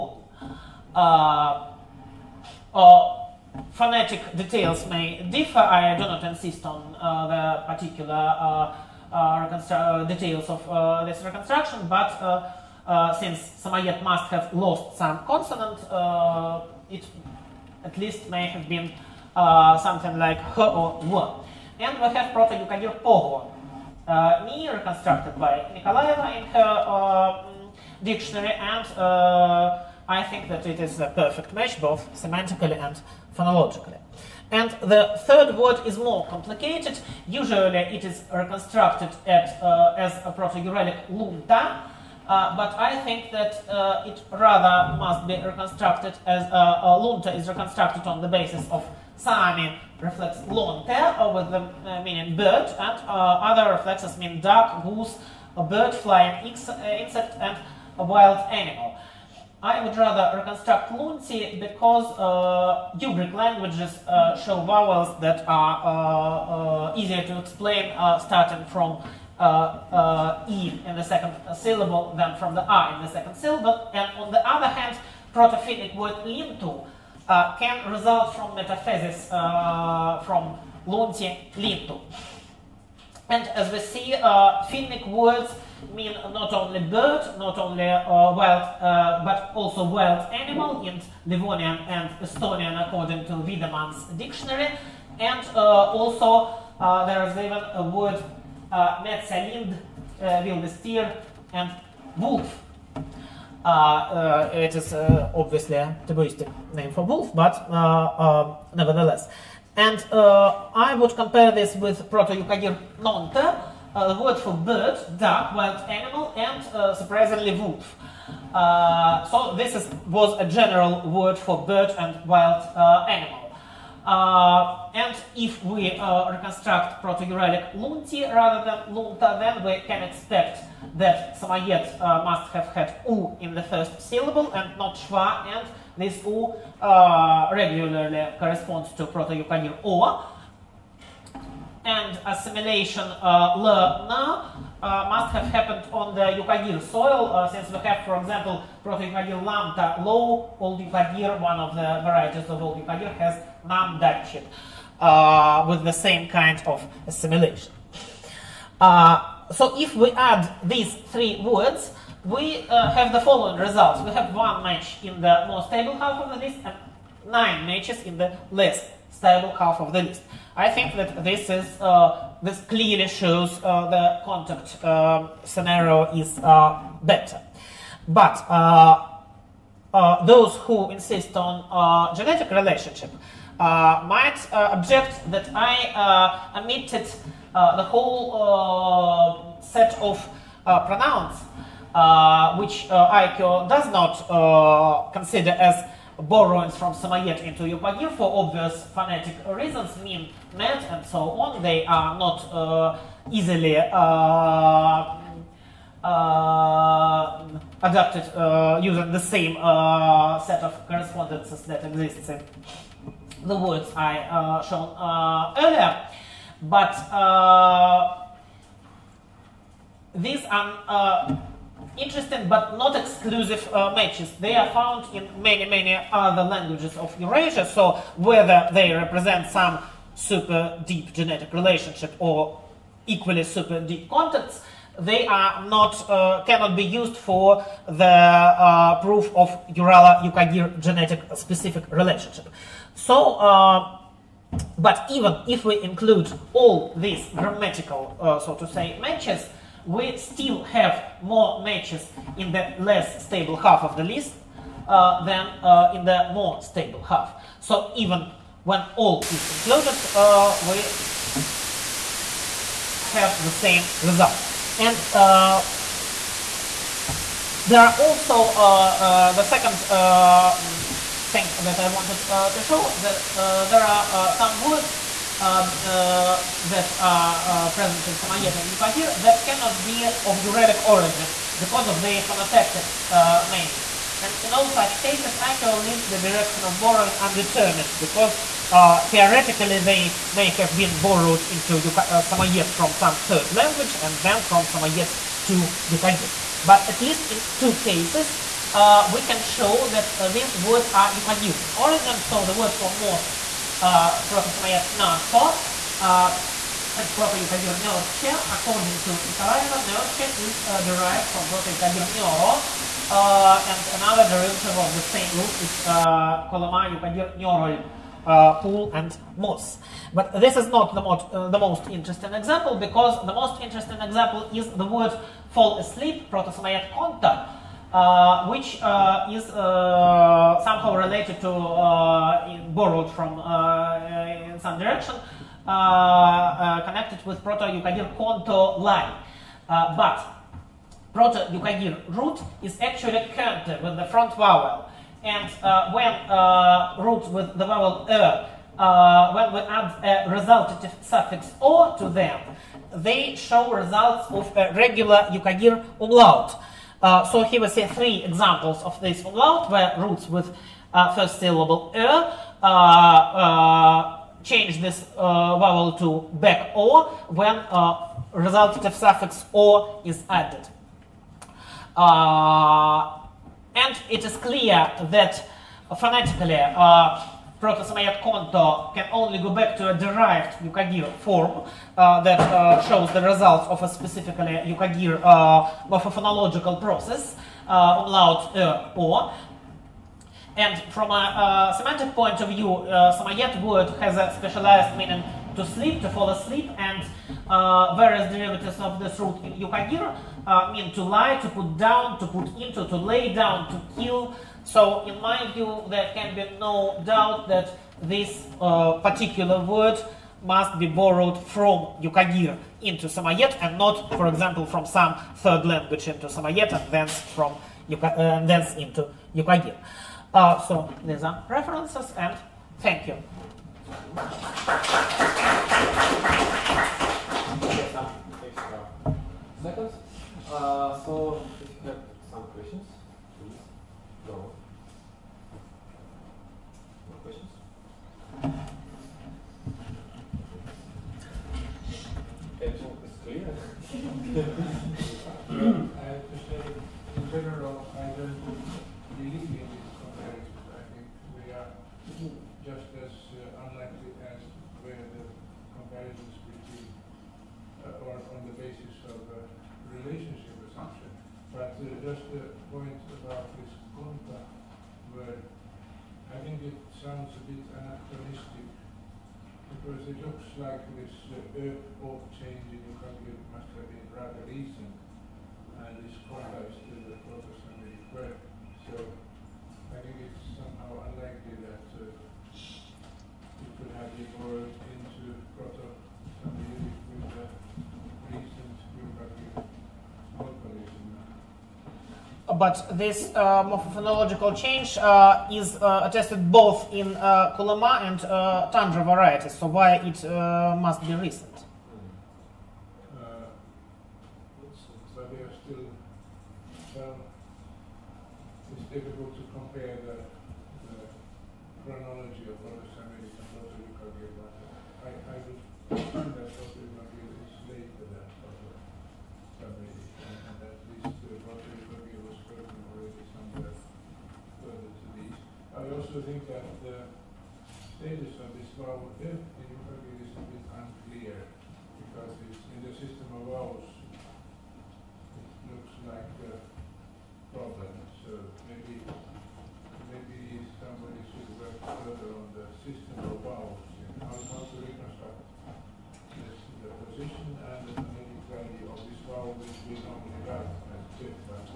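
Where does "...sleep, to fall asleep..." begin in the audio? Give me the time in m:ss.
6:35.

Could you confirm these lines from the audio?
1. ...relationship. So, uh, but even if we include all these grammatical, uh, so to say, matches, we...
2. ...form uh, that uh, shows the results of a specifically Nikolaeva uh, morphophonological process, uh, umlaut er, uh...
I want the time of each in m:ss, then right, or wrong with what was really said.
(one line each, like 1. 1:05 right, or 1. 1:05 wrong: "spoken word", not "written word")
1. 4:01 right
2. 6:21 wrong: "Yukagir", not "Nikolaeva".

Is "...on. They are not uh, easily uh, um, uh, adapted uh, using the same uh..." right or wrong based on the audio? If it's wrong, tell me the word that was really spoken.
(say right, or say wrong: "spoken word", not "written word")
right.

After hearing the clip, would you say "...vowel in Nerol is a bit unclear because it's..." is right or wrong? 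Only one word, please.
wrong.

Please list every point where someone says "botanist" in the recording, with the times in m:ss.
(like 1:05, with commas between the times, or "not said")
not said.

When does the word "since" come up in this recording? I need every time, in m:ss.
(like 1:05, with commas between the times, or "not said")
0:13, 2:27.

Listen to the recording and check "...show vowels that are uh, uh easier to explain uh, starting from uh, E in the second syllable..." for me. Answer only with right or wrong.
right.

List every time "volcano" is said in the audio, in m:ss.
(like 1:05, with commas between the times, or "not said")
not said.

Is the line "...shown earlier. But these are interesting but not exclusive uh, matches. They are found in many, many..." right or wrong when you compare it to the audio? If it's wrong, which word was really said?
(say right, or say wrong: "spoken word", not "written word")
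right.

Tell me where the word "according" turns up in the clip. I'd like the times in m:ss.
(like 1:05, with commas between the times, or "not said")
1:32, 5:08.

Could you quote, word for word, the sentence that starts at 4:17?
So even when all is included, uh, we have the same result.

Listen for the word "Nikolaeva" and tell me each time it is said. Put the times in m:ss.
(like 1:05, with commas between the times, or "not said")
0:25, 5:09.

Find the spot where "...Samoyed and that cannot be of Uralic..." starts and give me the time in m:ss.
4:38.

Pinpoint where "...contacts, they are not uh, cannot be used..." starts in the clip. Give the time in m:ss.
3:54.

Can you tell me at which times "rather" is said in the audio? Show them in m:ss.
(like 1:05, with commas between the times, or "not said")
0:44, 0:59, 2:08, 7:54.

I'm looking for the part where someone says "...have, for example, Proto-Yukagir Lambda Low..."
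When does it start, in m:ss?
2:27.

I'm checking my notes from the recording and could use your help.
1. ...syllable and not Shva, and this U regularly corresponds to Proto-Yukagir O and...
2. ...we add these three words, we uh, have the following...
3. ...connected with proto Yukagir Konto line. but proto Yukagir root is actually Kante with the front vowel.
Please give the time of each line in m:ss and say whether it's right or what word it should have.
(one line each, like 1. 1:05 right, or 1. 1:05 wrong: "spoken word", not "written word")
1. 2:14 right
2. 2:39 right
3. 5:35 right.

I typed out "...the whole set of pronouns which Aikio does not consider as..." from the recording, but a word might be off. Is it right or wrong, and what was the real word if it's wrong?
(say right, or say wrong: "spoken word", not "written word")
right.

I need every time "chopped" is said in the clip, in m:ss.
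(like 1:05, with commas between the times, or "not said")
not said.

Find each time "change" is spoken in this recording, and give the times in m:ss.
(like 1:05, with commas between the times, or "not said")
6:04, 7:52, 8:14.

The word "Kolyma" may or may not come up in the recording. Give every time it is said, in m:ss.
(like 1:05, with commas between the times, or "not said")
5:16, 8:17.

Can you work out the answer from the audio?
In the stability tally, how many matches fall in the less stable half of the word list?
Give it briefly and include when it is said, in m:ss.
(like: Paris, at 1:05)
9, at 2:47.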